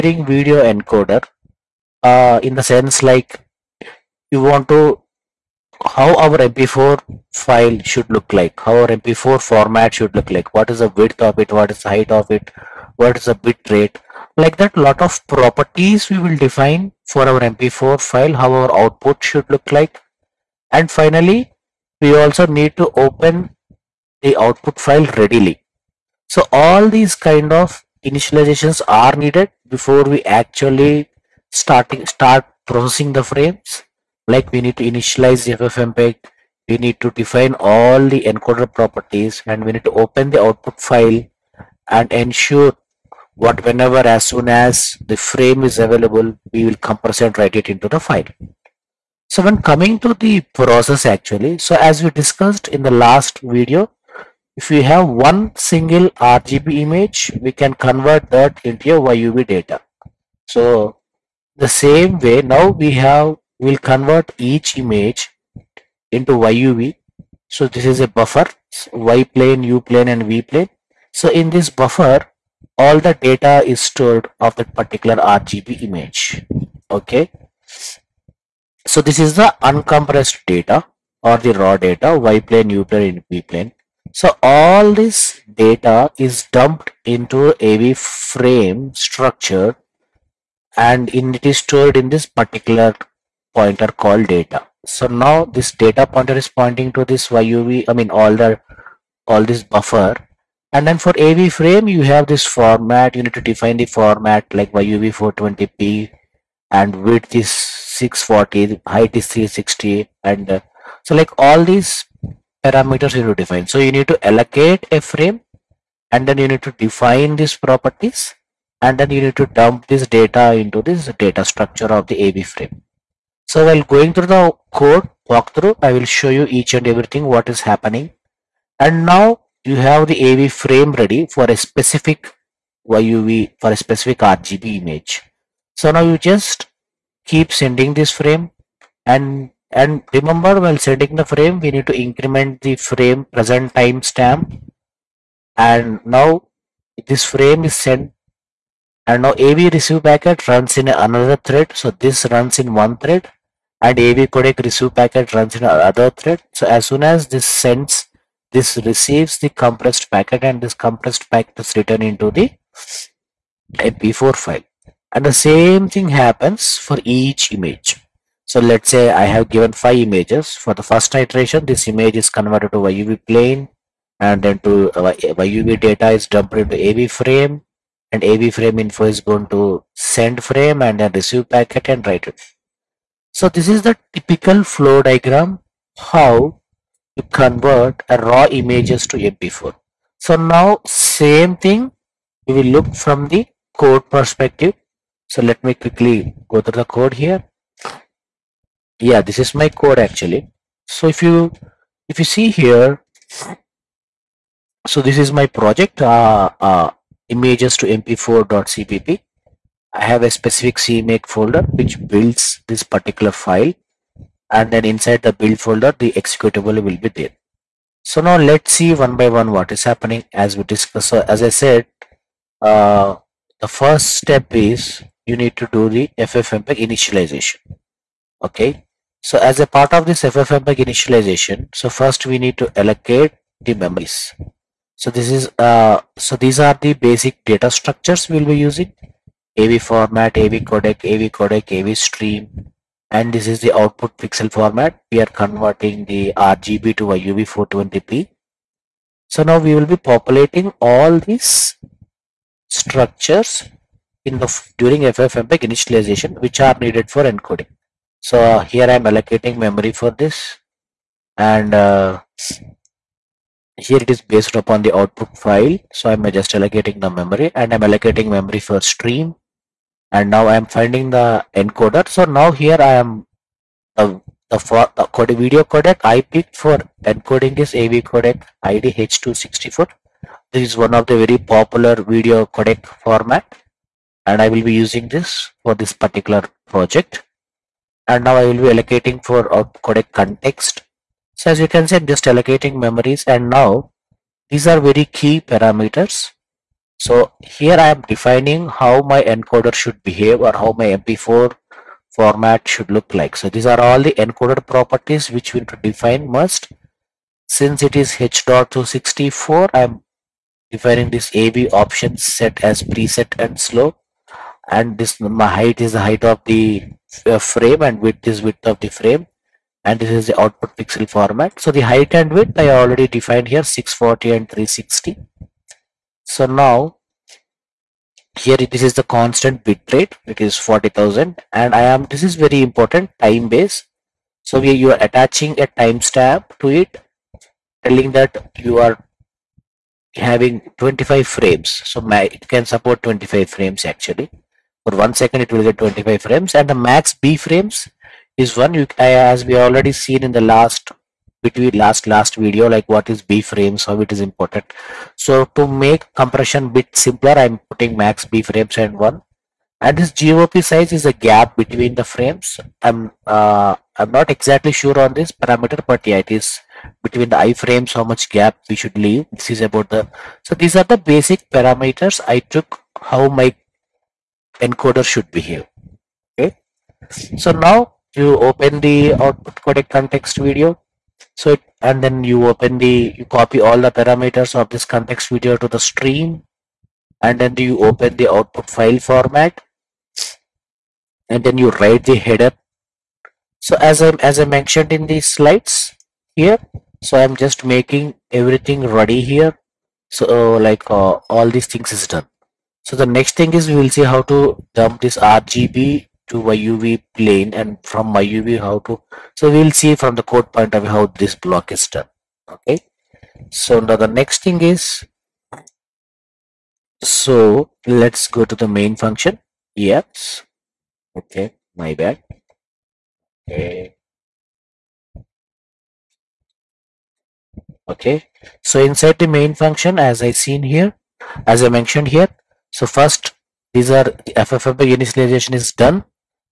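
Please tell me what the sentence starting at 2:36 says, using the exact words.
So as soon as this sends, this receives the compressed packet and this compressed packet is written into the MP4 file.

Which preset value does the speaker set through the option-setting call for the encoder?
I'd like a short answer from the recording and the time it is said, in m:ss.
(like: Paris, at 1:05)
slow, at 5:13.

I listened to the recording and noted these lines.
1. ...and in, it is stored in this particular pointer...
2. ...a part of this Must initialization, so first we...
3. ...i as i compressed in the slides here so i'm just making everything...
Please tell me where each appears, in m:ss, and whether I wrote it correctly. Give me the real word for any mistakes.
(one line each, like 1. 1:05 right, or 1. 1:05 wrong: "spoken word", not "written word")
1. 1:30 right
2. 3:49 wrong: "FFmpeg", not "Must"
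3. 6:34 wrong: "mentioned", not "compressed".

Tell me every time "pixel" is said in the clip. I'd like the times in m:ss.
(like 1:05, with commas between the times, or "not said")
4:04, 5:20.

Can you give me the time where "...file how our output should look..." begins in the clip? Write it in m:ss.
0:17.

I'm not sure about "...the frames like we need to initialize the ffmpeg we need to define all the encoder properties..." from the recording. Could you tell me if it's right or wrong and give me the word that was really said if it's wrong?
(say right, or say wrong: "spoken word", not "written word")
right.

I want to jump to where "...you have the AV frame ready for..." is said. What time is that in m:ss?
2:09.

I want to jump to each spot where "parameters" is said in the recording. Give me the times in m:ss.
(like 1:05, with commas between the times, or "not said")
1:52, 4:55, 6:05, 6:11, 6:23.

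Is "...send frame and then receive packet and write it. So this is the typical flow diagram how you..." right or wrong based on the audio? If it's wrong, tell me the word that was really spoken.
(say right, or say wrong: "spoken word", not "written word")
right.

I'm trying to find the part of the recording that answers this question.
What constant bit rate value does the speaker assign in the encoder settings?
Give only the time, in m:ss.
5:30.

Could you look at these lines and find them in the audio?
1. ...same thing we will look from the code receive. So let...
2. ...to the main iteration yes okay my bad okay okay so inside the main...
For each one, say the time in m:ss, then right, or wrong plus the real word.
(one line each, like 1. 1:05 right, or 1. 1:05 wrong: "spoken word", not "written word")
1. 3:10 wrong: "perspective", not "receive"
2. 6:58 wrong: "function", not "iteration".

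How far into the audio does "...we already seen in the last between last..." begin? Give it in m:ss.
5:49.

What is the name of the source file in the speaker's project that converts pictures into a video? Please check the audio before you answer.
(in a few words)
images_to_mp4.cpp.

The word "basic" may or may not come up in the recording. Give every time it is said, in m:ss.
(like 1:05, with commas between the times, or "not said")
3:56, 6:10.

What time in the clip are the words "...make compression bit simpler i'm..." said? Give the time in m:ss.
5:55.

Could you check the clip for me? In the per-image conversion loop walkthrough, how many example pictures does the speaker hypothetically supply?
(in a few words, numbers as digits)
5.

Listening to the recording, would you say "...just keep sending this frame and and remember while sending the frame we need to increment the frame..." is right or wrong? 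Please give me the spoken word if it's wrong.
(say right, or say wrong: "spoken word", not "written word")
right.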